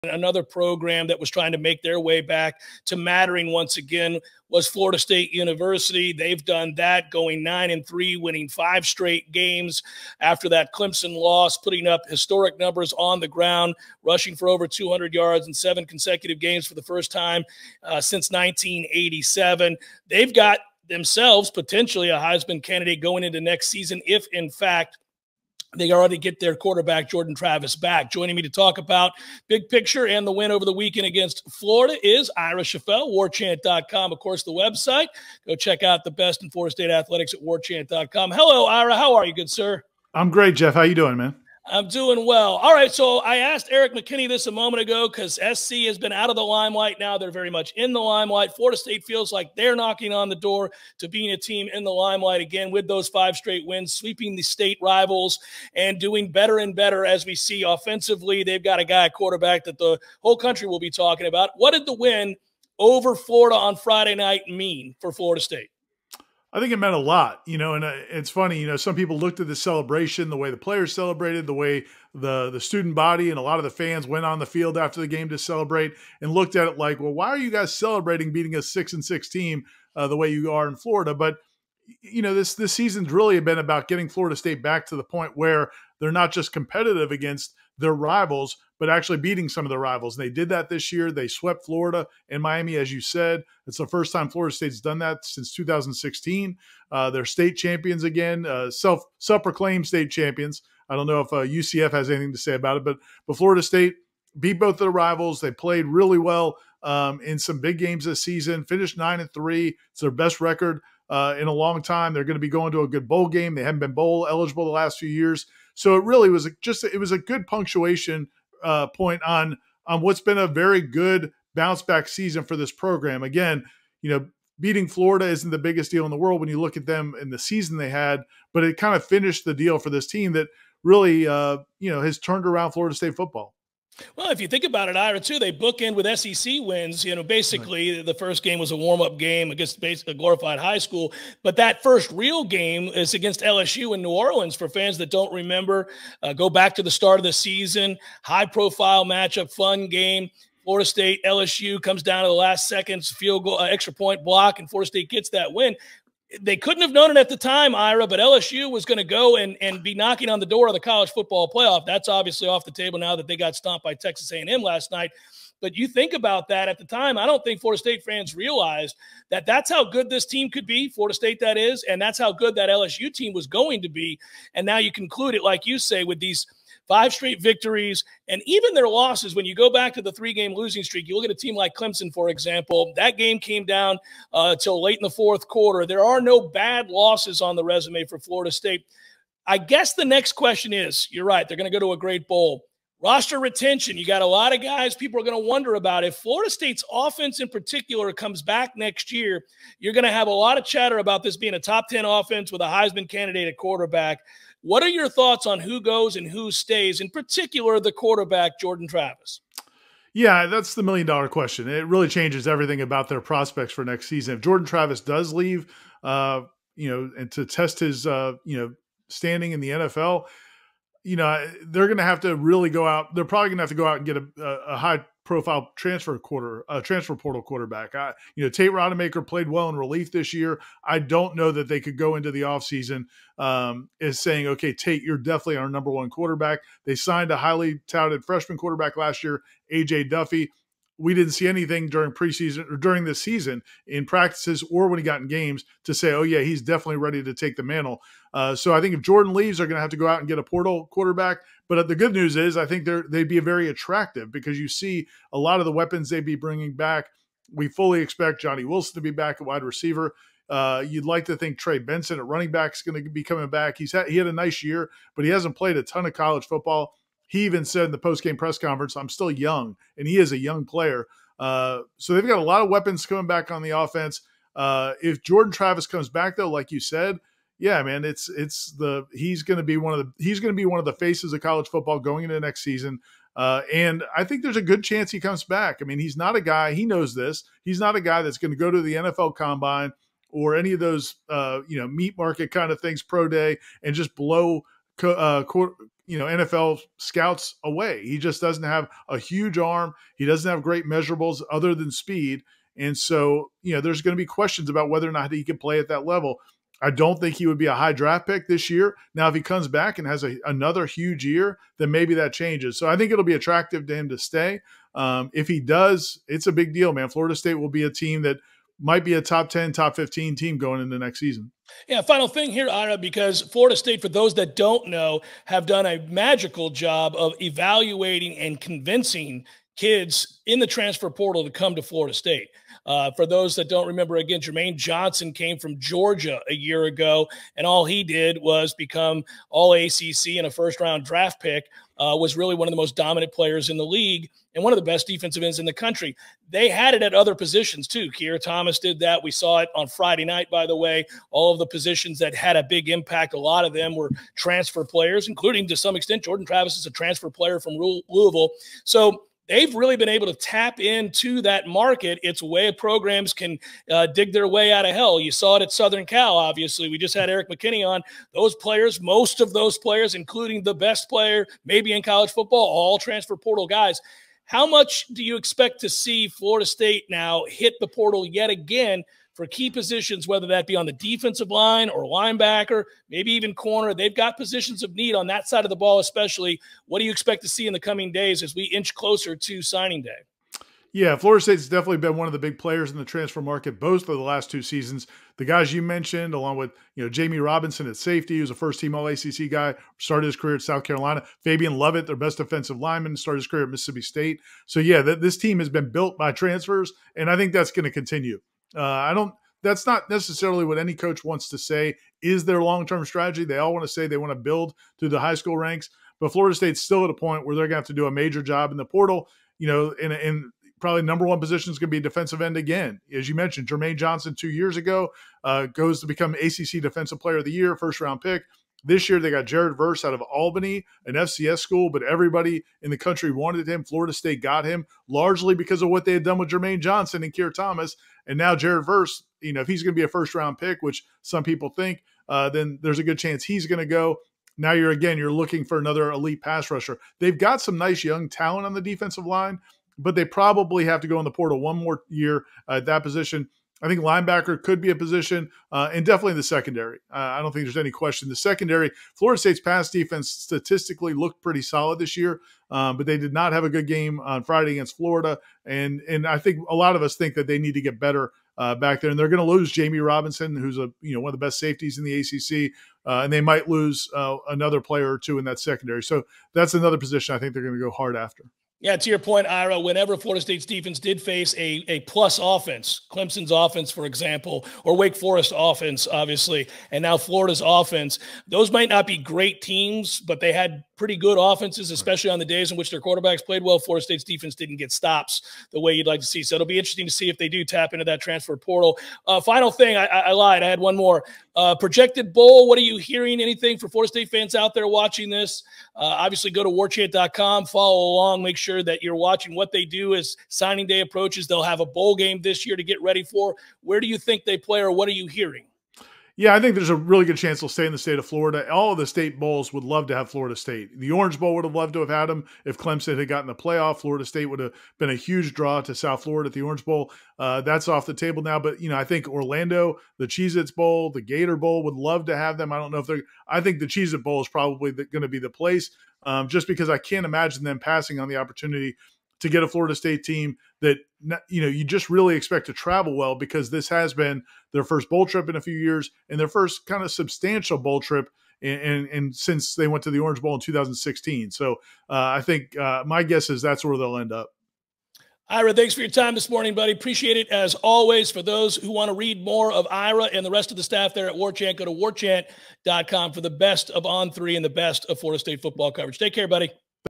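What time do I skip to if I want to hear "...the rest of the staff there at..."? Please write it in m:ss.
9:20.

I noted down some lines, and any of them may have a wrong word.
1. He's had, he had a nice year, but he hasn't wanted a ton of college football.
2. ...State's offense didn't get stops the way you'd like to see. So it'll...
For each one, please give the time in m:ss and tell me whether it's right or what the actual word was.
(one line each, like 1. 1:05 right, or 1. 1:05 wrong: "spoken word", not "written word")
1. 4:23 wrong: "played", not "wanted"
2. 8:14 wrong: "defense", not "offense".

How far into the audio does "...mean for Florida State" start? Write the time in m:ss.
1:04.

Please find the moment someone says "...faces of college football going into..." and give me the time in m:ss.
4:40.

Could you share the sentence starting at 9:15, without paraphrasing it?
Ira, thanks for your time this morning, buddy.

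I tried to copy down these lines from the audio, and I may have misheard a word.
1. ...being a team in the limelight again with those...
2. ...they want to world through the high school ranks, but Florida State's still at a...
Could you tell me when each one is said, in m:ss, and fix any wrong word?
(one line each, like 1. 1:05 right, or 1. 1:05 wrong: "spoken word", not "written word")
1. 0:51 right
2. 6:54 wrong: "build", not "world".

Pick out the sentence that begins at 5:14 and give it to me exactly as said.
Um, if he does, it's a big deal, man.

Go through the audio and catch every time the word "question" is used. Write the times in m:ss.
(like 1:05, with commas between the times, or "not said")
3:10, 3:31, 5:04, 7:37.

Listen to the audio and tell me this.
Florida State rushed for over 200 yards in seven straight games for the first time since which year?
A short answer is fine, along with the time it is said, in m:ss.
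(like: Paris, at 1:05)
1987, at 0:18.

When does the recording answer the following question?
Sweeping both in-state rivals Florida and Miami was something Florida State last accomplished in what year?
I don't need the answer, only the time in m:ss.
1:35.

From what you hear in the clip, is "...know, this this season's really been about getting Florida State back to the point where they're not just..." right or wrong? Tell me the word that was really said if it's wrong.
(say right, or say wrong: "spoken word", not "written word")
right.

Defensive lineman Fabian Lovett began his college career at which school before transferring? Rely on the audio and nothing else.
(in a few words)
Mississippi State.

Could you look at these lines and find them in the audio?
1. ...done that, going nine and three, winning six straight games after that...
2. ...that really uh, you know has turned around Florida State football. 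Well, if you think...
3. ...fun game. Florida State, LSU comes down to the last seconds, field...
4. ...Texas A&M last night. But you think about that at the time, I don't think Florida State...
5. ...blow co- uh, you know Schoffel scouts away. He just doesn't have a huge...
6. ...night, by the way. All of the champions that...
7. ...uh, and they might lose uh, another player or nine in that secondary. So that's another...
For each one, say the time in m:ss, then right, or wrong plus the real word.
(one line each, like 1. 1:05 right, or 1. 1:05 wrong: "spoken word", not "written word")
1. 0:06 wrong: "five", not "six"
2. 2:10 right
3. 2:29 right
4. 2:43 right
5. 4:54 wrong: "NFL", not "Schoffel"
6. 5:50 wrong: "positions", not "champions"
7. 7:53 wrong: "two", not "nine".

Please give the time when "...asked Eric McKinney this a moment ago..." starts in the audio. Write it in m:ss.
0:43.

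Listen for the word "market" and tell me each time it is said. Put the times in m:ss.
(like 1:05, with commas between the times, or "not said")
4:52, 6:01, 6:33.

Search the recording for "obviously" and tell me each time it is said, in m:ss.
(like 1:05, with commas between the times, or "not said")
2:42, 6:06, 8:06, 8:25.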